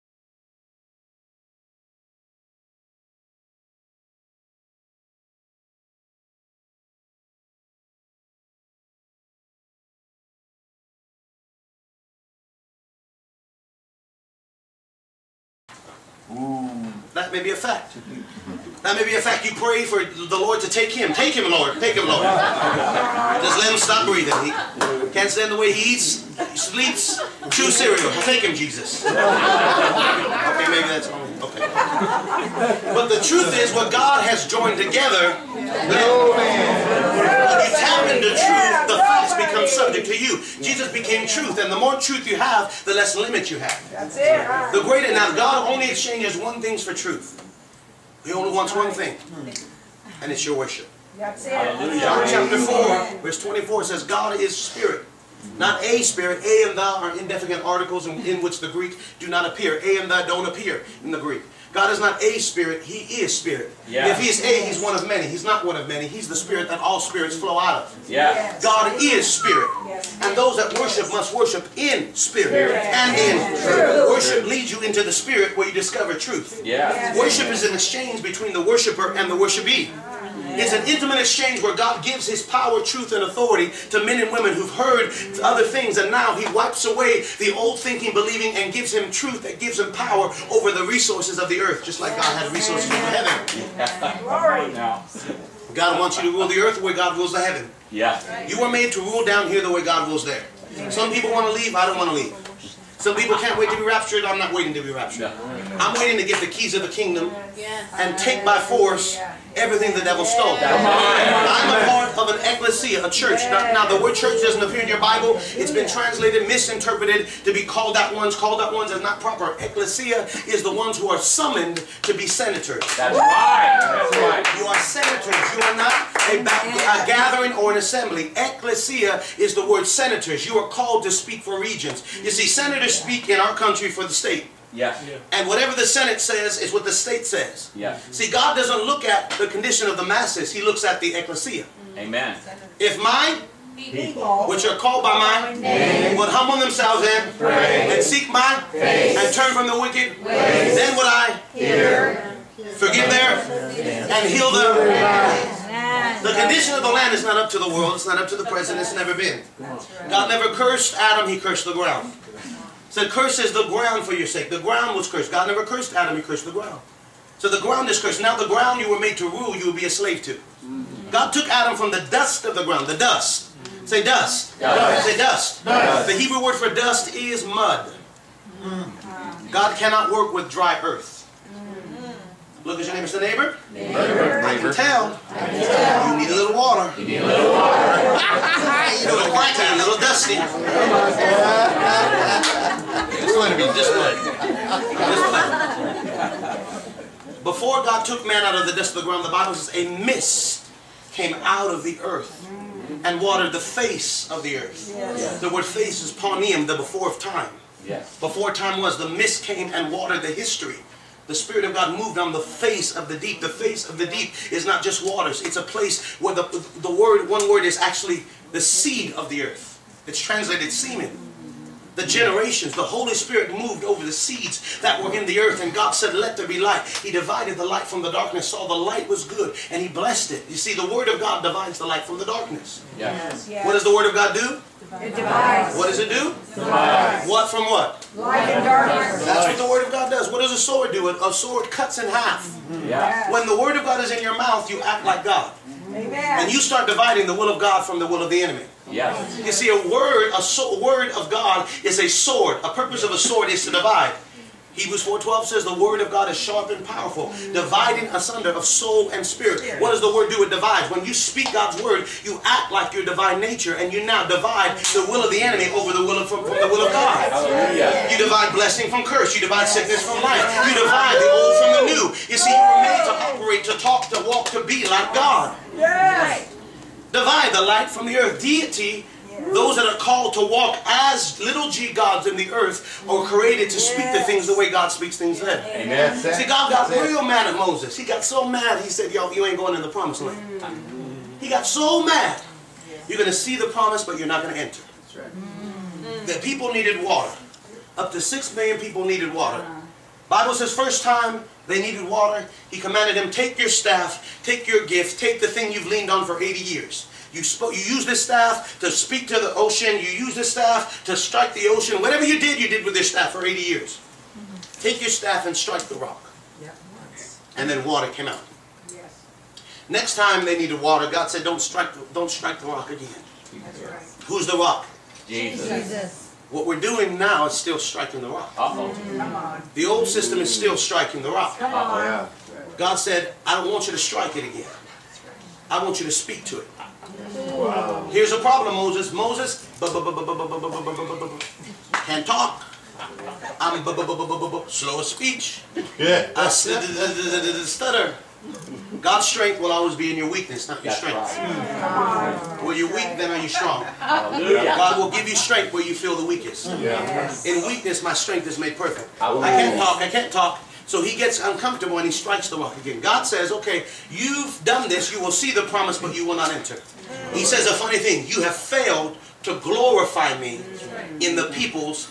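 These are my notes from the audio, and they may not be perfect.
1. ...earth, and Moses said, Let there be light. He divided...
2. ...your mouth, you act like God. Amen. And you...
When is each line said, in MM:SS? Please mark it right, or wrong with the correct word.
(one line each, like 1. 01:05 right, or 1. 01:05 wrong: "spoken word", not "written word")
1. 03:45 wrong: "God", not "Moses"
2. 04:04 right.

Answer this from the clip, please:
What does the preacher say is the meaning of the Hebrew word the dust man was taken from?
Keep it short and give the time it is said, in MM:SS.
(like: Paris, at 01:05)
Mud, at 02:57.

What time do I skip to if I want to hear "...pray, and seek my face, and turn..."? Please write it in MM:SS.
02:27.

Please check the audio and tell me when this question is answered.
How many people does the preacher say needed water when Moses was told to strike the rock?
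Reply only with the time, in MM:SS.
04:58.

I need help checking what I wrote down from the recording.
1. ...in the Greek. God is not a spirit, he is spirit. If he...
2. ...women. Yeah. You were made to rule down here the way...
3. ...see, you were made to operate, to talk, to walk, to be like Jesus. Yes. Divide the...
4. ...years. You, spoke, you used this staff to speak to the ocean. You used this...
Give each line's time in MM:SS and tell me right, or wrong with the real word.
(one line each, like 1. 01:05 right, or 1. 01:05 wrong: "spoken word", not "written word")
1. 01:01 right
2. 01:37 wrong: "heaven", not "women"
3. 04:32 wrong: "God", not "Jesus"
4. 05:06 right.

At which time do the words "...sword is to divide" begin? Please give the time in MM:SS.
04:13.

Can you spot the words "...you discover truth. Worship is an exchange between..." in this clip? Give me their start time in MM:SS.
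01:15.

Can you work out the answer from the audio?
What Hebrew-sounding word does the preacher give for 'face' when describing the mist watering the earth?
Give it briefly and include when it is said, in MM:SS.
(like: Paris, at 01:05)
Paunium, at 03:26.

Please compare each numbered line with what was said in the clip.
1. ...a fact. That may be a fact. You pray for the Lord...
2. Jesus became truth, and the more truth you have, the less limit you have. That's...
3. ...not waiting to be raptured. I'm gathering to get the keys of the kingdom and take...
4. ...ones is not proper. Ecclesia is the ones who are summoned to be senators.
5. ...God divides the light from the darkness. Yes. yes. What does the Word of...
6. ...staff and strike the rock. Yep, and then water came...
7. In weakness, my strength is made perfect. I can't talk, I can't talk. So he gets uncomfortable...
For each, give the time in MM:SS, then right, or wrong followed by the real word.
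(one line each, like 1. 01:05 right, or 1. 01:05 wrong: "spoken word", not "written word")
1. 00:17 right
2. 00:40 right
3. 01:44 wrong: "waiting", not "gathering"
4. 01:58 right
5. 03:51 right
6. 05:15 right
7. 05:57 right.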